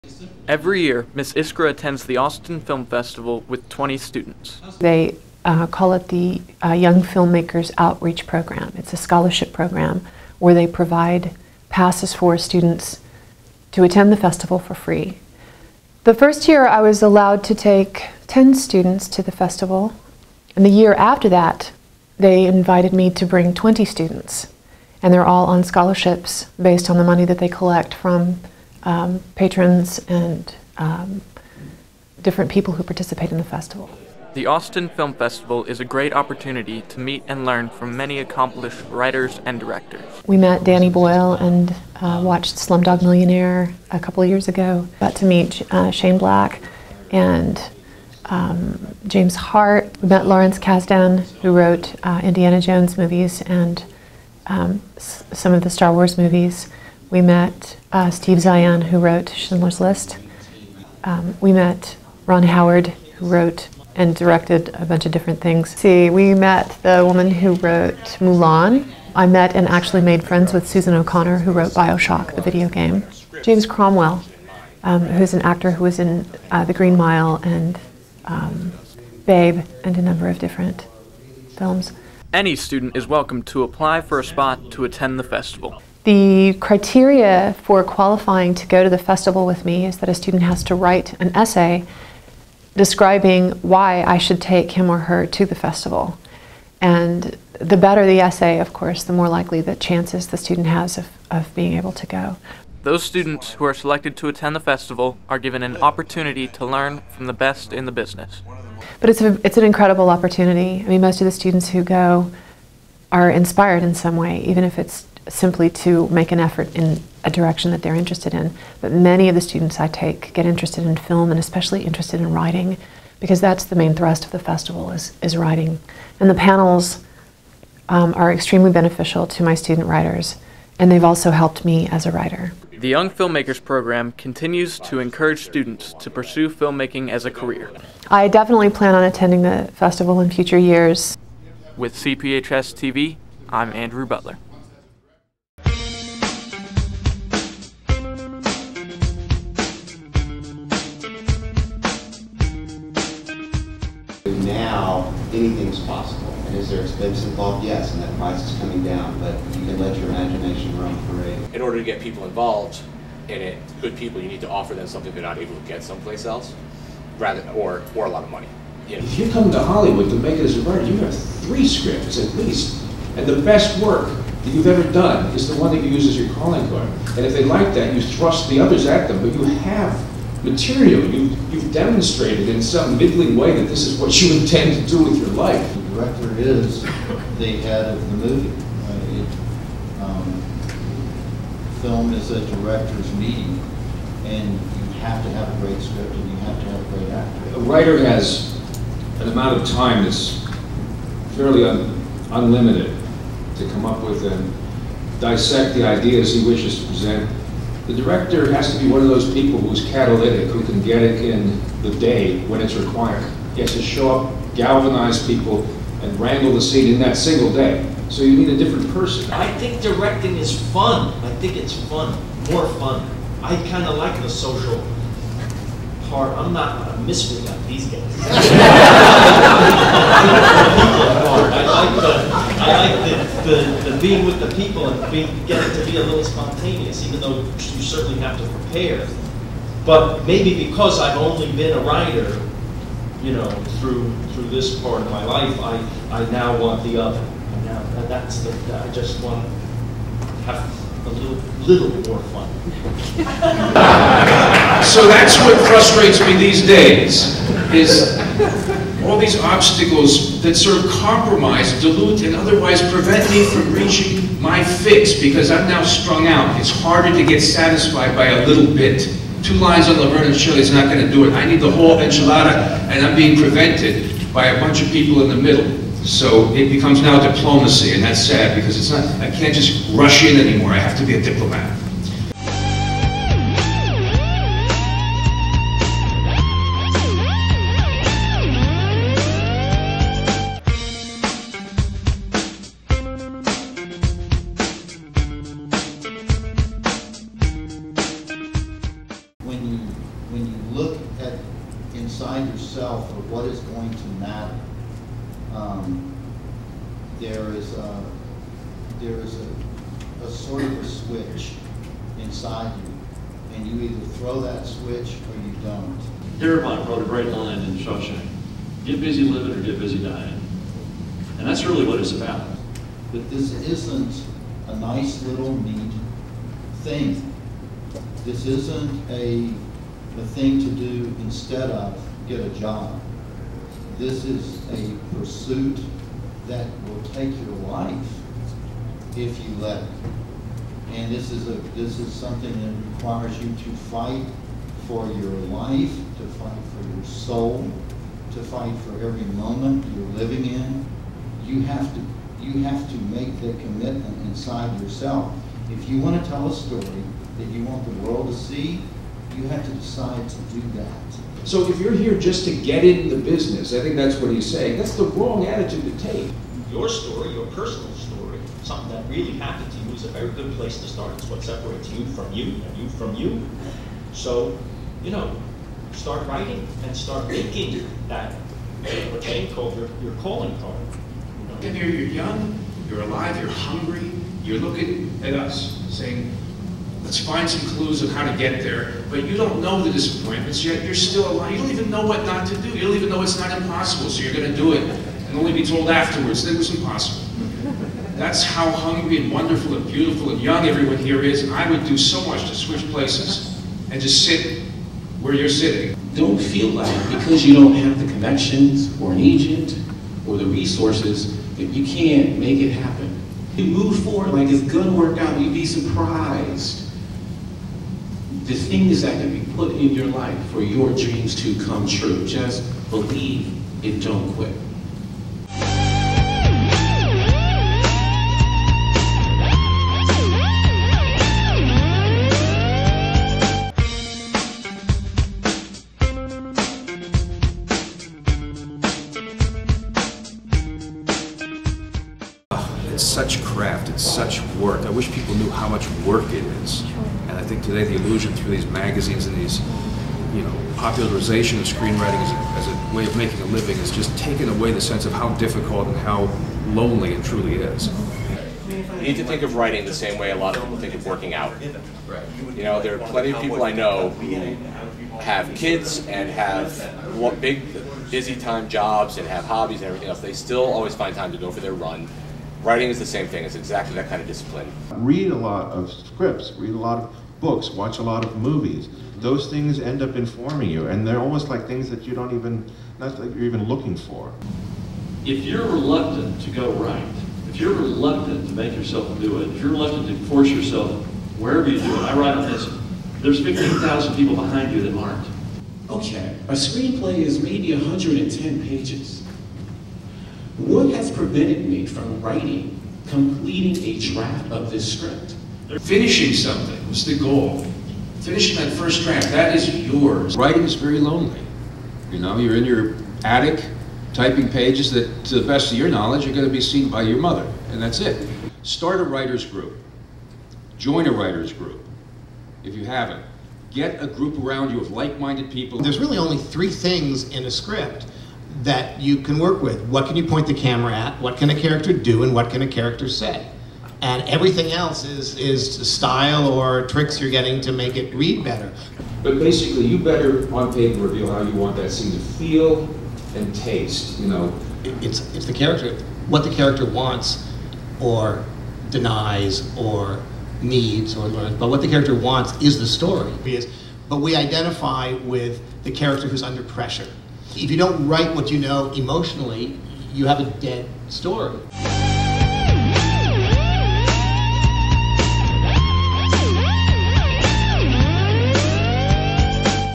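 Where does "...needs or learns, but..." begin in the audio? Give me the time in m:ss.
9:10.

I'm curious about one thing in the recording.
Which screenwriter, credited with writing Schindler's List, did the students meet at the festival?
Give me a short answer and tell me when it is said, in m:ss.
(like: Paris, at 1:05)
Steve Zaillian, at 0:58.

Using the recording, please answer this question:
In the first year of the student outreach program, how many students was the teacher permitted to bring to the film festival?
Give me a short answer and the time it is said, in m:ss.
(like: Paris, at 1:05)
10, at 0:18.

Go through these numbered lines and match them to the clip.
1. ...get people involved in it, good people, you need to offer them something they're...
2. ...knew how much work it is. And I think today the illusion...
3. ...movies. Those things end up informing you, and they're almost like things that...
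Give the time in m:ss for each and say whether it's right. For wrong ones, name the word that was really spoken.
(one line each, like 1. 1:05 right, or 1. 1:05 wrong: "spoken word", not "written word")
1. 2:41 right
2. 7:25 right
3. 7:58 right.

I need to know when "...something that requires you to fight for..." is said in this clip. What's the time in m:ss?
5:42.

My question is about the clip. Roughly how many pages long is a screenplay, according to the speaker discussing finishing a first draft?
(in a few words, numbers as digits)
110.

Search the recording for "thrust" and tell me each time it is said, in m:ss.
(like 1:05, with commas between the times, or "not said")
2:03, 2:58.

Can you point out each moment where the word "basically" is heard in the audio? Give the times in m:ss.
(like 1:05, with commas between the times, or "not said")
8:59.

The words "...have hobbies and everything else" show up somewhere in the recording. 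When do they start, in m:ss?
7:49.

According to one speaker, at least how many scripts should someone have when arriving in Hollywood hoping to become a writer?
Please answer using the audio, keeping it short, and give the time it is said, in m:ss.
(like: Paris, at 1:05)
3, at 2:51.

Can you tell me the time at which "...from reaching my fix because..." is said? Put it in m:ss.
4:23.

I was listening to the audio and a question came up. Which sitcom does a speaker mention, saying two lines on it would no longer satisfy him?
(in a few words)
Laverne and Shirley.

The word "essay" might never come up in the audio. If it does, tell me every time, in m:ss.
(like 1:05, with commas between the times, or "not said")
1:31, 1:38.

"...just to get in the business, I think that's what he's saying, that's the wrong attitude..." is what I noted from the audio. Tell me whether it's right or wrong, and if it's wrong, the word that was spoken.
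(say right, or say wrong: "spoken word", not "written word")
right.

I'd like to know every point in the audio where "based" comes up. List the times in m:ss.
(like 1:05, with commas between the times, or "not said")
0:26.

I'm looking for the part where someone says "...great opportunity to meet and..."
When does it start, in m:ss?
0:35.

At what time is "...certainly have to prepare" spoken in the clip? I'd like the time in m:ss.
3:57.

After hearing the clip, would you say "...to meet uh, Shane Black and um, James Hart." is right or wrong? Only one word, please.
right.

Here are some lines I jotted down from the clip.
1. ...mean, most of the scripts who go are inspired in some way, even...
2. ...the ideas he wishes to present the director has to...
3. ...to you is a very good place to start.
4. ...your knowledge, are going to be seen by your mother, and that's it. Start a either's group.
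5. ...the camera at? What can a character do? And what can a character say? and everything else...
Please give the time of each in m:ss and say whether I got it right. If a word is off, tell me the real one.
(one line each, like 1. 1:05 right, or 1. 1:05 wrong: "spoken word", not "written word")
1. 1:50 wrong: "students", not "scripts"
2. 3:25 right
3. 6:09 right
4. 8:35 wrong: "writer", not "either"
5. 8:50 right.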